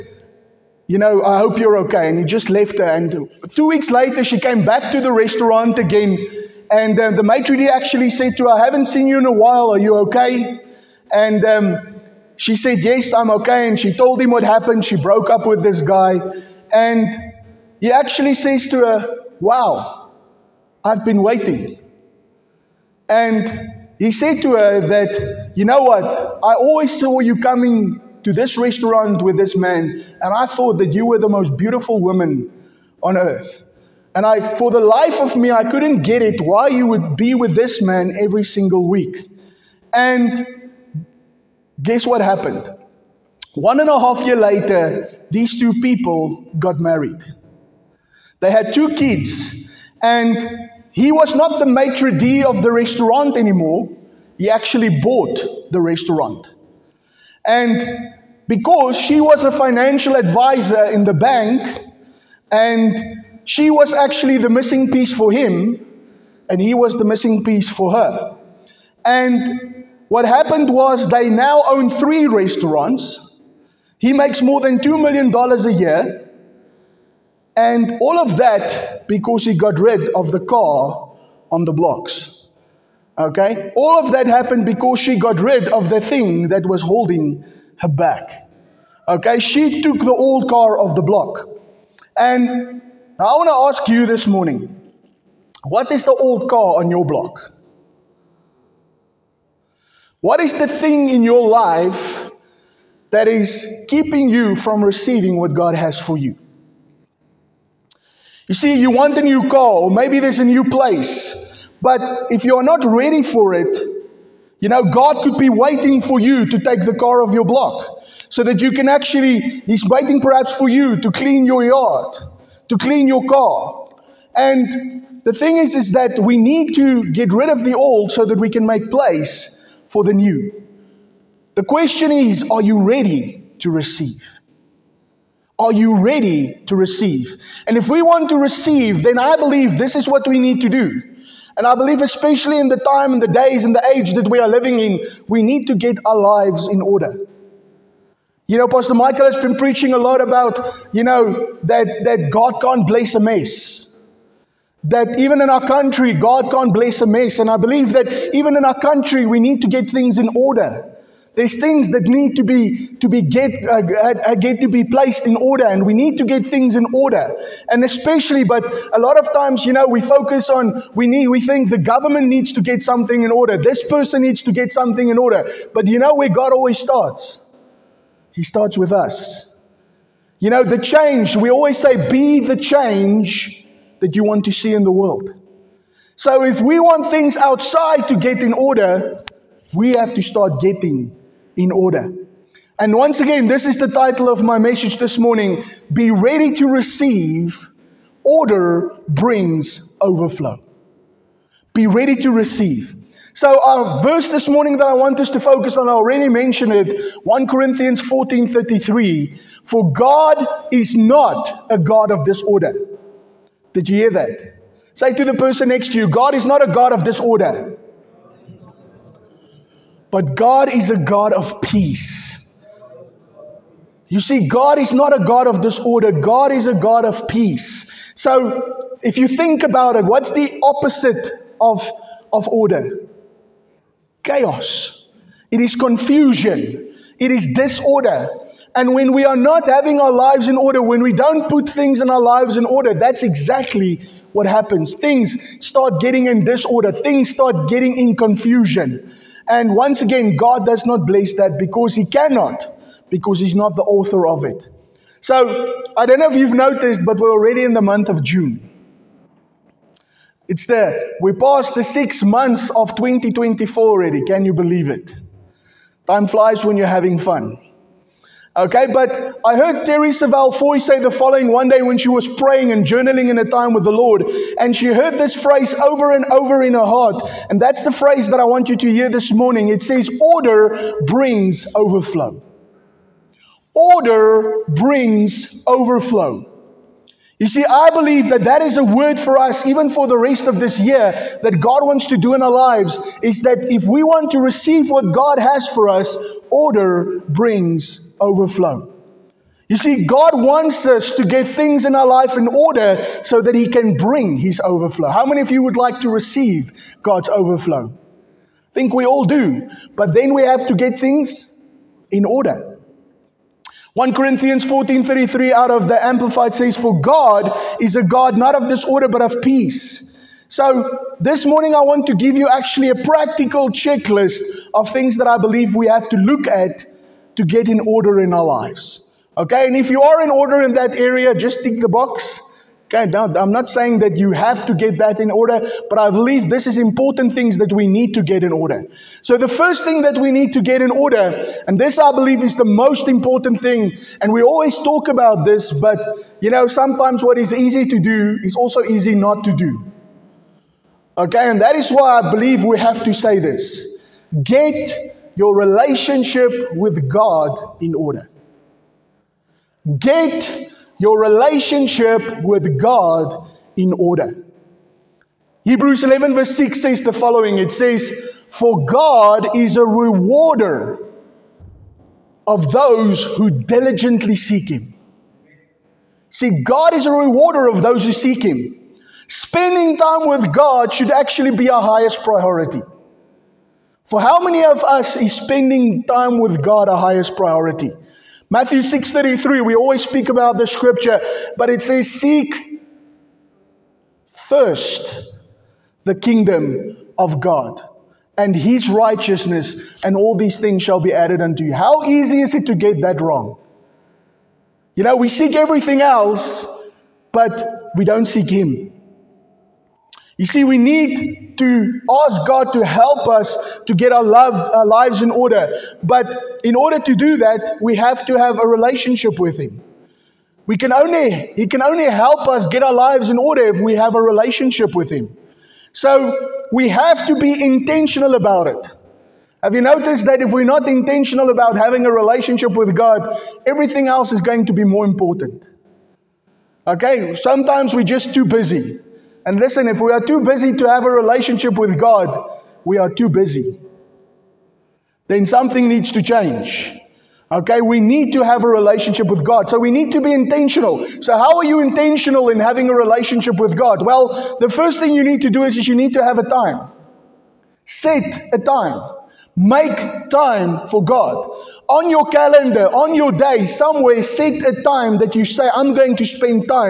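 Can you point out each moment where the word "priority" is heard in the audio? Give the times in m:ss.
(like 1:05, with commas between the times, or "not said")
6:22, 6:27.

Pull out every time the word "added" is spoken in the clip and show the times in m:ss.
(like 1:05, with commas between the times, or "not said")
6:41.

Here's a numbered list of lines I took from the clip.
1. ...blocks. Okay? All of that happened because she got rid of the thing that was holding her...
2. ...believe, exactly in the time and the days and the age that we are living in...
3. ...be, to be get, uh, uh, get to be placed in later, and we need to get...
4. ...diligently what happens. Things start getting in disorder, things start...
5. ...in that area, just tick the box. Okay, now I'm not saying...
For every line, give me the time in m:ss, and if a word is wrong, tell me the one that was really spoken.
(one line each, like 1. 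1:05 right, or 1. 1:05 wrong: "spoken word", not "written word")
1. 1:21 right
2. 2:21 wrong: "especially", not "exactly"
3. 2:42 wrong: "order", not "later"
4. 4:03 wrong: "exactly", not "diligently"
5. 5:30 right.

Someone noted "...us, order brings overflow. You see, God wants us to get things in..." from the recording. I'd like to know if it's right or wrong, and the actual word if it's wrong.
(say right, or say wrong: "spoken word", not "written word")
right.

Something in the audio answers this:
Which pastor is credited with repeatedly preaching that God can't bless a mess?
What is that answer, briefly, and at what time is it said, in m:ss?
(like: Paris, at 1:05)
Pastor Michael, at 2:28.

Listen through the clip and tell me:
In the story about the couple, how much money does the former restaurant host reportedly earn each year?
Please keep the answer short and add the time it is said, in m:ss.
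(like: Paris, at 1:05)
$2 million, at 1:14.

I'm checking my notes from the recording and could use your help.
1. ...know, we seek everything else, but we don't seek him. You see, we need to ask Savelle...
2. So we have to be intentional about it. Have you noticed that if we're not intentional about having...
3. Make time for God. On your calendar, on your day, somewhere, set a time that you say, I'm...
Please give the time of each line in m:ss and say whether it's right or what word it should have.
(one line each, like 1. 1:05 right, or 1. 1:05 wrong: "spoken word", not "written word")
1. 6:45 wrong: "God", not "Savelle"
2. 7:05 right
3. 7:39 right.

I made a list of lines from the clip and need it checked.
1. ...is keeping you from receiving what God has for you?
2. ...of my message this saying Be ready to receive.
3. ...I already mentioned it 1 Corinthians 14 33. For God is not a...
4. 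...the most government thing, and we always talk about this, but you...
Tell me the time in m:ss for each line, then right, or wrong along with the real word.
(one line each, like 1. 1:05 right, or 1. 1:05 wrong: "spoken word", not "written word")
1. 1:43 right
2. 3:14 wrong: "morning", not "saying"
3. 3:25 right
4. 5:42 wrong: "important", not "government".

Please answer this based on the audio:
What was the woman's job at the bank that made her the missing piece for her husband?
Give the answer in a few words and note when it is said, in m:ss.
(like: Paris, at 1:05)
financial advisor, at 0:59.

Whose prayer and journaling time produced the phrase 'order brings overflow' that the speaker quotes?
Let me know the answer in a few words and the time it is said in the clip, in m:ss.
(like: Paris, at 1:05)
Terri Savelle Foy, at 4:29.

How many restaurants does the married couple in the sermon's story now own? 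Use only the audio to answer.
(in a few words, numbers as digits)
3.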